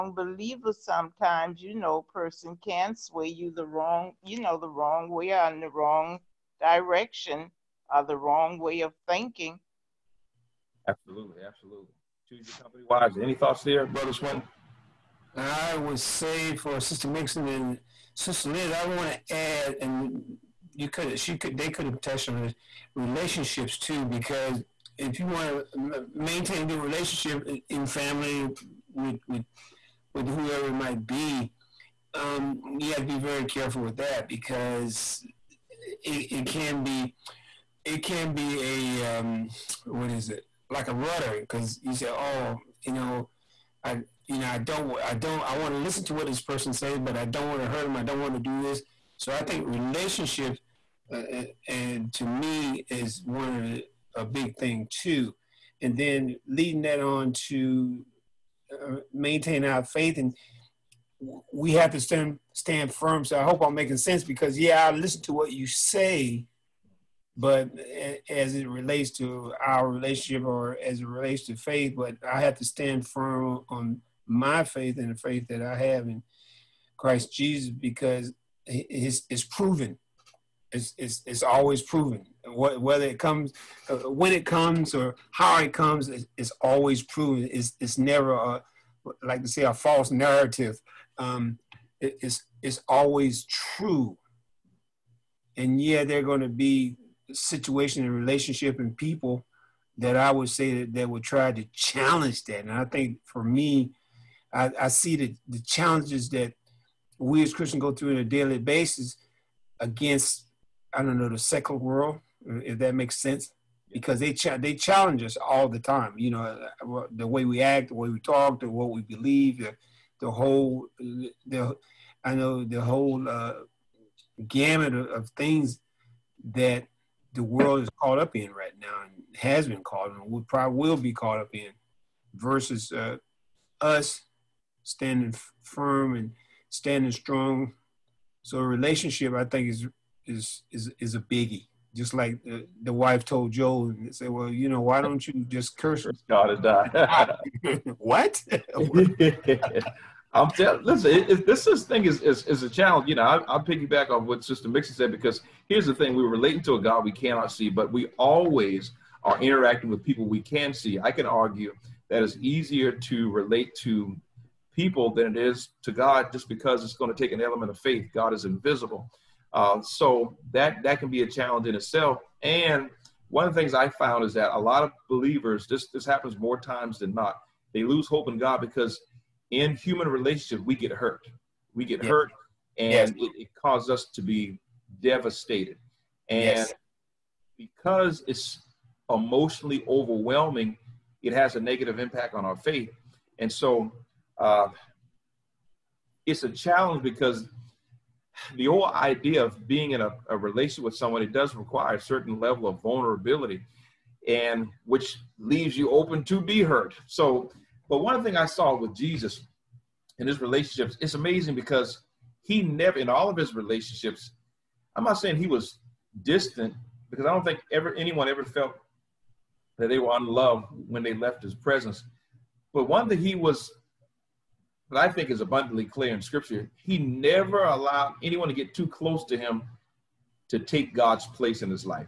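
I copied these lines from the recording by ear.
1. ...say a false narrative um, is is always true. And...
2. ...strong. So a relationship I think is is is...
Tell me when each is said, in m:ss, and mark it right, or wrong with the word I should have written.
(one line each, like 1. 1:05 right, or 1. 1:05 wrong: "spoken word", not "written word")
1. 1:29 right
2. 2:17 right.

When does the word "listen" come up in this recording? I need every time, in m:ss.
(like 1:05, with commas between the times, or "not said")
0:45, 1:04, 2:30.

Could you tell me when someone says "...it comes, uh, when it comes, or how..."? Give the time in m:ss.
1:23.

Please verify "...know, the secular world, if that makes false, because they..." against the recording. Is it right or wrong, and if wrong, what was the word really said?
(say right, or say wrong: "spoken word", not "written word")
wrong: "sense", not "false".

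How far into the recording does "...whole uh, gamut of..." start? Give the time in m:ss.
2:02.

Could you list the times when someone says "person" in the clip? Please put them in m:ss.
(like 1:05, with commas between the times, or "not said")
0:02, 0:46.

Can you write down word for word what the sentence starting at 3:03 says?
it, it, causes us to be devastated.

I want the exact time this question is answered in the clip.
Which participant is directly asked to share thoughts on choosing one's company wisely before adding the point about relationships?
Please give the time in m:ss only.
0:13.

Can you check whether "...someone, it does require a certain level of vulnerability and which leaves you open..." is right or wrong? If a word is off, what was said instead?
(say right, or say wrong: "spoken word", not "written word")
right.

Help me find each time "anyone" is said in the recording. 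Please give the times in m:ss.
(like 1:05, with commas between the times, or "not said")
3:37, 3:48.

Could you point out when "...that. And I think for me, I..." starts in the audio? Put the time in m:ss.
1:42.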